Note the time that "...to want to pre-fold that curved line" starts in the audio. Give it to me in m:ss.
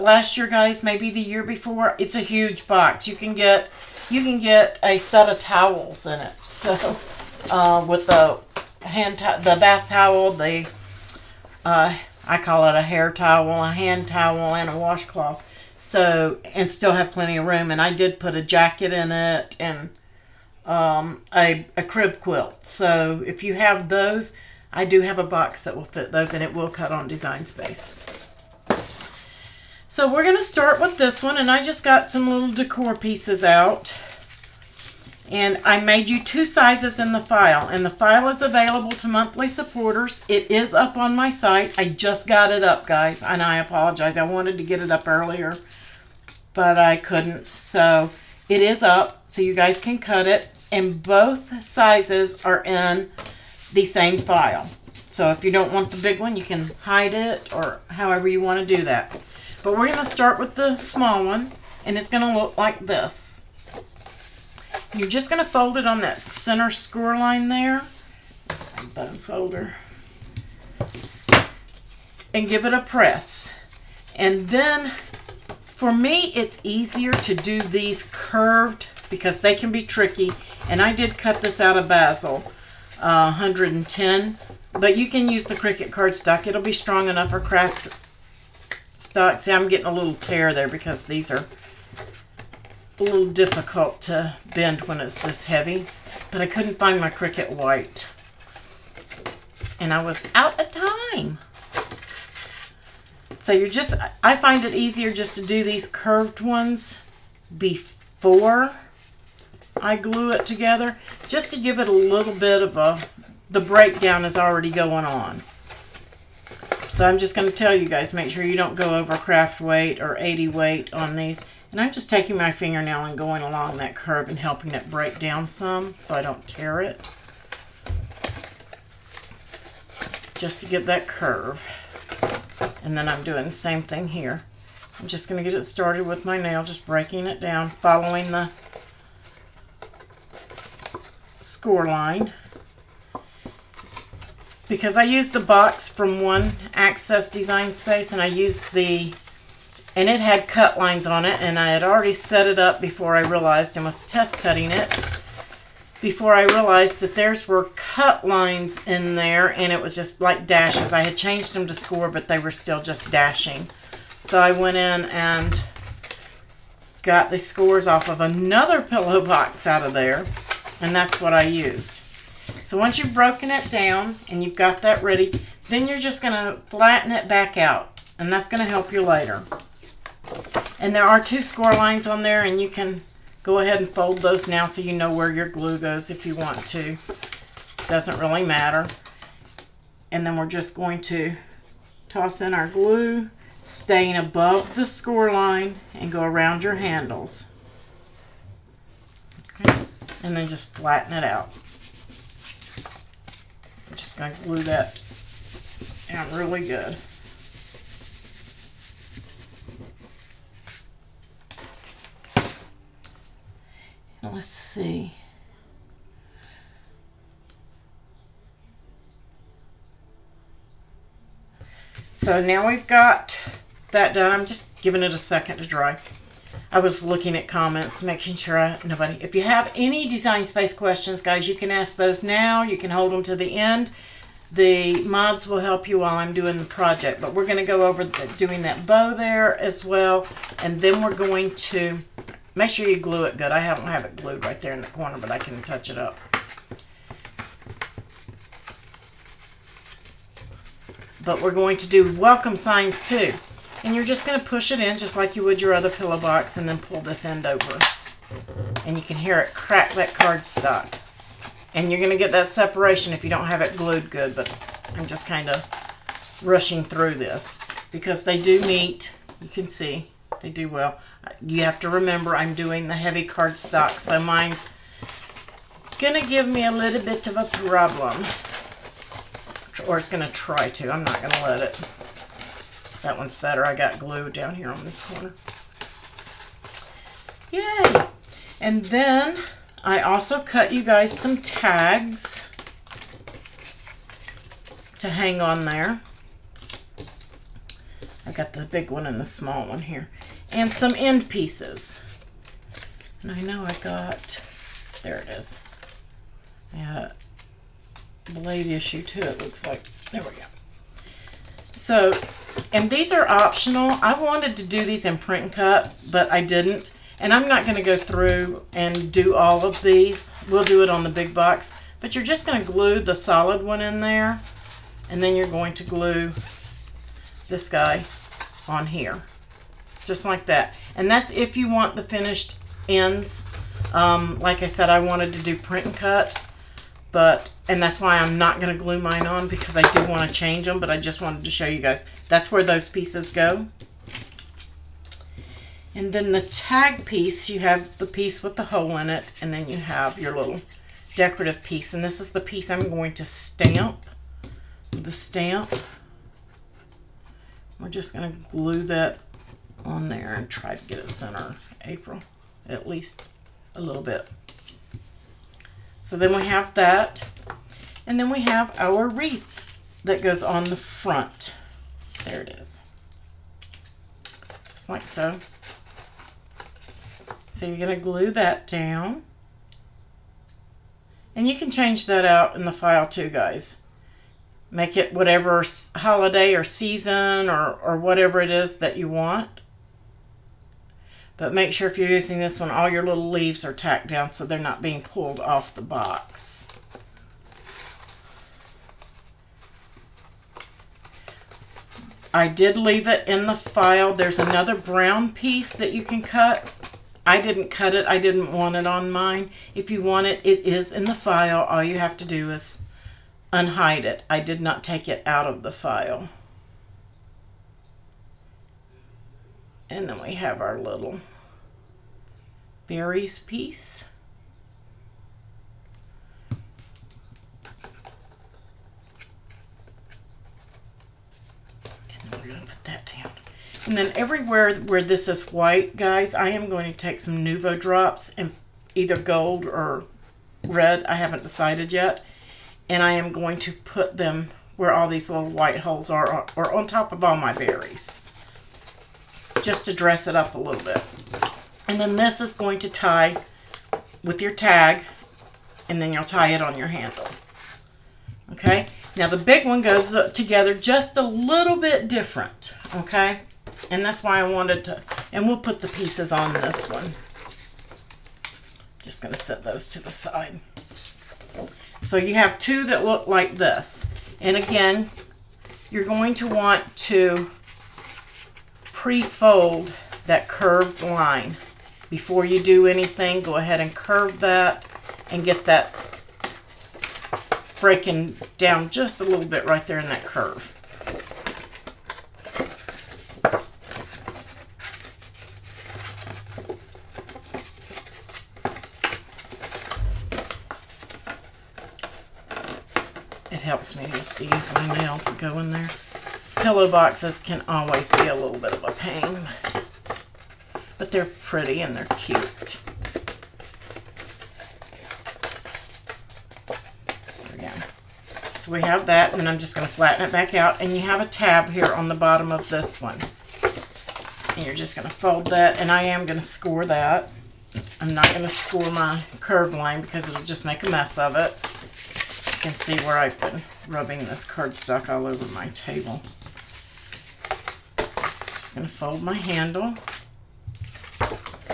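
7:56.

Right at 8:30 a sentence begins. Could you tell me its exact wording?
But they're pretty and they're cute.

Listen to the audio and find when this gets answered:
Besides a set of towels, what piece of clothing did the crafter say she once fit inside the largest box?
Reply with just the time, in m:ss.
0:18.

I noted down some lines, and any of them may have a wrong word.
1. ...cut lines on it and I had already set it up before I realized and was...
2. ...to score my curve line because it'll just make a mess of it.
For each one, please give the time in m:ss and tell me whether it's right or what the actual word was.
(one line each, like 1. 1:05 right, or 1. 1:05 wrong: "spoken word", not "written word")
1. 2:30 right
2. 8:48 right.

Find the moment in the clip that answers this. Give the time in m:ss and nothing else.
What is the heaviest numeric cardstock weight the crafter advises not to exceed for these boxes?
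2:00.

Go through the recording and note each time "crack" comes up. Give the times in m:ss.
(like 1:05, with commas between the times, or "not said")
4:19.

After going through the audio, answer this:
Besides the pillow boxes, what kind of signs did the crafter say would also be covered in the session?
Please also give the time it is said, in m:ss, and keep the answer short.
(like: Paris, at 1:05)
welcome signs, at 4:12.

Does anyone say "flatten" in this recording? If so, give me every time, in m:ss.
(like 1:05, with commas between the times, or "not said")
2:56, 3:20, 8:39.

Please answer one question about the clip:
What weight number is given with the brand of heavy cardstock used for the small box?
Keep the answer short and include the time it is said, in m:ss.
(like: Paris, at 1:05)
110, at 1:23.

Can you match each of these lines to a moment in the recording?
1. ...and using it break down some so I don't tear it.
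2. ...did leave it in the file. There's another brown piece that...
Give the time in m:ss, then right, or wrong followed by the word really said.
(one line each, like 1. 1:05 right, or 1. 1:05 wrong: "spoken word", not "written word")
1. 2:04 wrong: "helping", not "using"
2. 6:42 right.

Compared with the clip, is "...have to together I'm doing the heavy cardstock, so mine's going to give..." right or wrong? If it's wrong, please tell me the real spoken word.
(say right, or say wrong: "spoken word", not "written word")
wrong: "remember", not "together".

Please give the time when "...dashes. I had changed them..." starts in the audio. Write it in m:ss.
2:40.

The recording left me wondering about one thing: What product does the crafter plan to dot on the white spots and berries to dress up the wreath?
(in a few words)
Nuvo drops.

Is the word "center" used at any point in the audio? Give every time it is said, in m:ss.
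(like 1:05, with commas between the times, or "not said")
1:06, 6:01.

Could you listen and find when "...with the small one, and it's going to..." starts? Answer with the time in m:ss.
1:00.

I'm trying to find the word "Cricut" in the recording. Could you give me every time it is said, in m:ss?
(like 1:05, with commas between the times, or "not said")
1:25, 1:37.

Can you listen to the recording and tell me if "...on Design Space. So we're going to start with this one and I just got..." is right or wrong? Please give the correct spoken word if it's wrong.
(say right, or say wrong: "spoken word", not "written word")
right.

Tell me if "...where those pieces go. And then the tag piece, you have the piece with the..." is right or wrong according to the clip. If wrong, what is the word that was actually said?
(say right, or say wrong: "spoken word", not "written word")
right.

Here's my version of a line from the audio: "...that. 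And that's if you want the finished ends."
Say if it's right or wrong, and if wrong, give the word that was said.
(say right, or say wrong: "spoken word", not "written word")
right.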